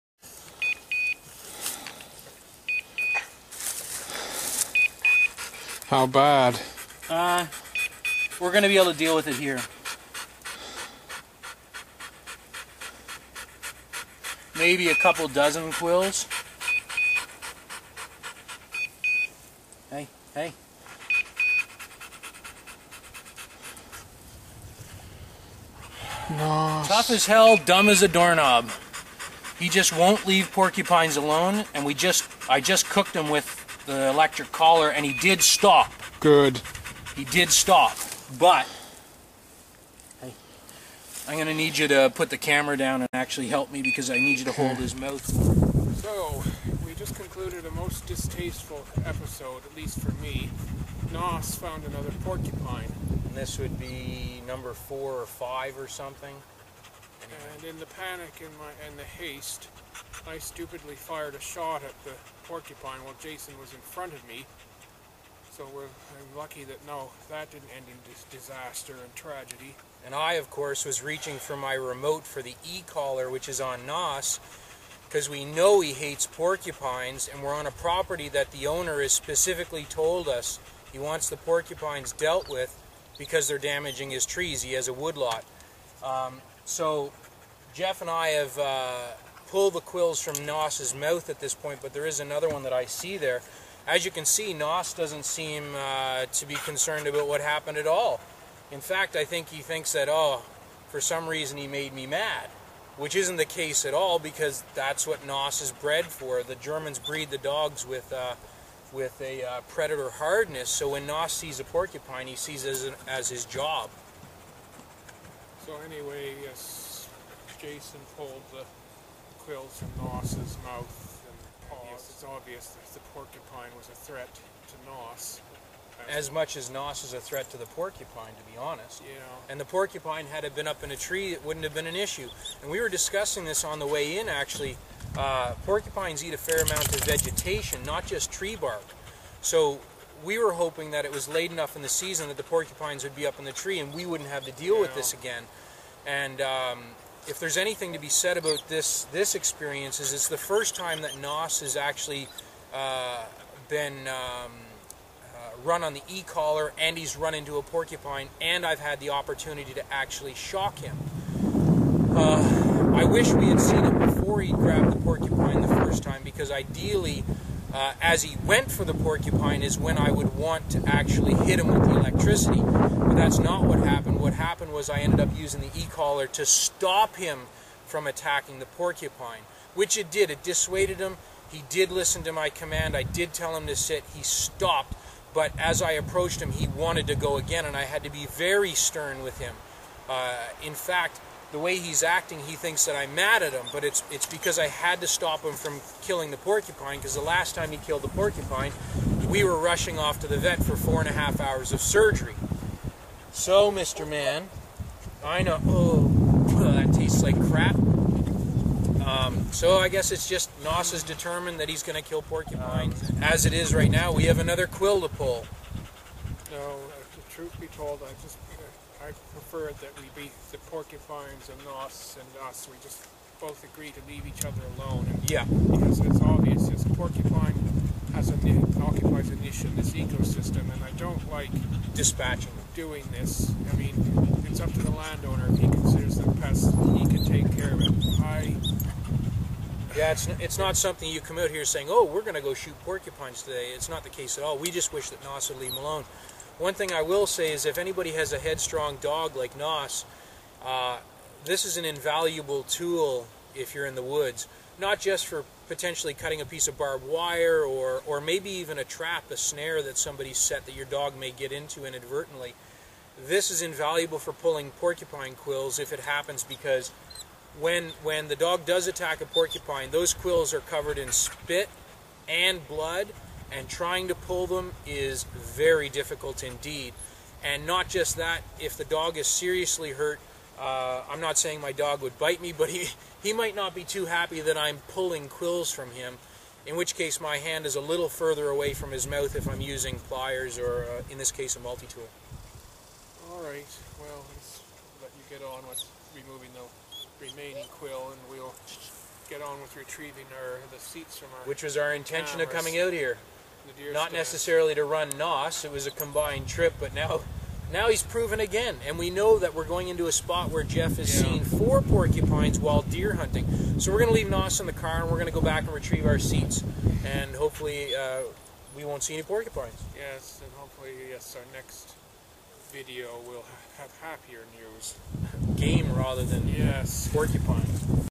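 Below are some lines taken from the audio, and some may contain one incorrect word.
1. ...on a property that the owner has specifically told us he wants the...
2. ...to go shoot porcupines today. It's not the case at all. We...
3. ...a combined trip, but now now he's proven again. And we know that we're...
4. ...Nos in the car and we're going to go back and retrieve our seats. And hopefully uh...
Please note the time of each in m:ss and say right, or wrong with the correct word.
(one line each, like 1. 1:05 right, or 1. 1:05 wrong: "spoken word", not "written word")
1. 1:17 right
2. 4:02 right
3. 5:05 right
4. 5:14 right.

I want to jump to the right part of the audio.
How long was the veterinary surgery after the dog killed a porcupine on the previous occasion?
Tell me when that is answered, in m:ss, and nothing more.
3:20.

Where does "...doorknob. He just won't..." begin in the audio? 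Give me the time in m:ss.
0:28.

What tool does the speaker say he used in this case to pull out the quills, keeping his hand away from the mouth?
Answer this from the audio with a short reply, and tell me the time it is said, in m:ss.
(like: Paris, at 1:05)
A multi-tool, at 4:51.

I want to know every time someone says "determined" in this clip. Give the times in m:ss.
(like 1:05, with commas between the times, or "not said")
3:31.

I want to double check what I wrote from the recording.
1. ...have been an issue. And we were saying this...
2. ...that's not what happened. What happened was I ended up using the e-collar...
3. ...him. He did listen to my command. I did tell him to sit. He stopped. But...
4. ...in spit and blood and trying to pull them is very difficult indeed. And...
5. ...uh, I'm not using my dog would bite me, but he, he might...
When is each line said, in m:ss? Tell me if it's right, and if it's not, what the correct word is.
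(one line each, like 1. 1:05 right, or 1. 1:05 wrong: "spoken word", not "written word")
1. 2:11 wrong: "discussing", not "saying"
2. 2:53 right
3. 3:00 right
4. 4:30 right
5. 4:40 wrong: "saying", not "using".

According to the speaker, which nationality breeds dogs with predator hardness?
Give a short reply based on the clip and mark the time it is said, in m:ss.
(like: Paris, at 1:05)
The Germans, at 1:46.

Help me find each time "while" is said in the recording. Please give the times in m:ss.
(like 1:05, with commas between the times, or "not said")
1:03, 5:12.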